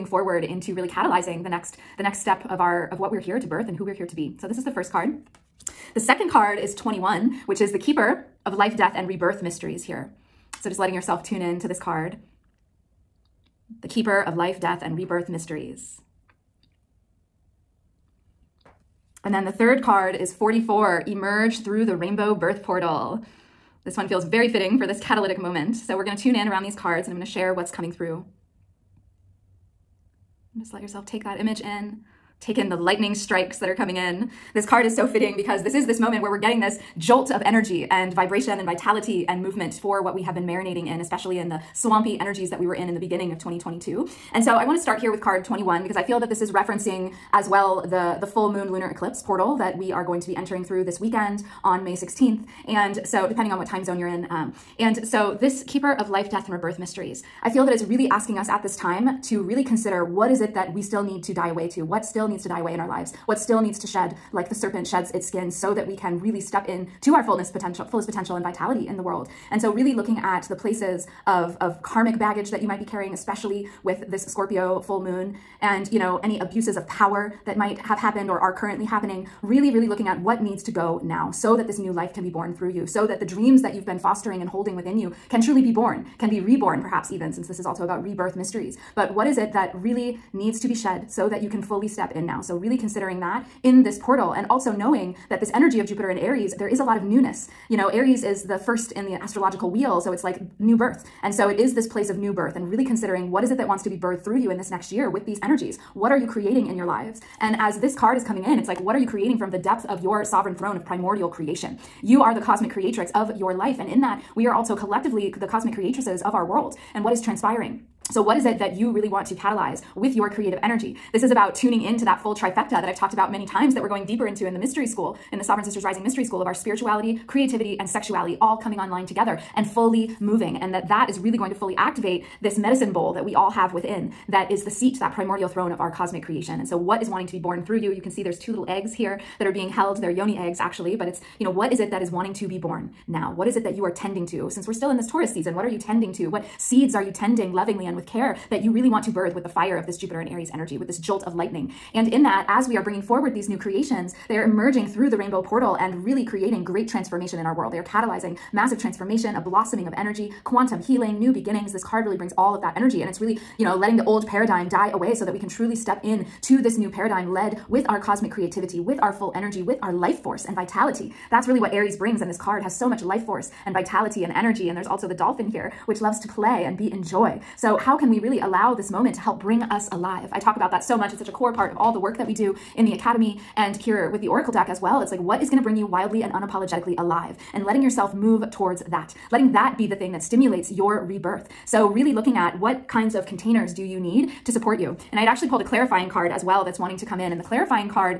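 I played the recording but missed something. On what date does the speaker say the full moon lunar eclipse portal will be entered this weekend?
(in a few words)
May 16.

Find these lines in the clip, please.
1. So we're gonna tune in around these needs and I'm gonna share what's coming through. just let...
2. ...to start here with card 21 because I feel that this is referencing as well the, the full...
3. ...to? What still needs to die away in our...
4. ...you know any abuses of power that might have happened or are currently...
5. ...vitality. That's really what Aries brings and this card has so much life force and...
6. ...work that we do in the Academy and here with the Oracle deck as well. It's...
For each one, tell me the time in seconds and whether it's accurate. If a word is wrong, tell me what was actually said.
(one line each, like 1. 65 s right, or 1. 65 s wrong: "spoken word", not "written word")
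1. 25 s wrong: "cards", not "needs"
2. 44 s right
3. 61 s right
4. 75 s right
5. 170 s right
6. 181 s right.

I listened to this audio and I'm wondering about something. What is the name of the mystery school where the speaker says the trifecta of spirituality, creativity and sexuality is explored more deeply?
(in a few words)
Sovereign Sisters Rising Mystery School.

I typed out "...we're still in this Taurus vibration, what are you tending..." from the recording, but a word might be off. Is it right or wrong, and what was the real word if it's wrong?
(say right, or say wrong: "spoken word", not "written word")
wrong: "season", not "vibration".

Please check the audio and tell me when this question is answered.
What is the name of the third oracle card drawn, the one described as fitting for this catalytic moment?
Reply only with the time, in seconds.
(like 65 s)
21 s.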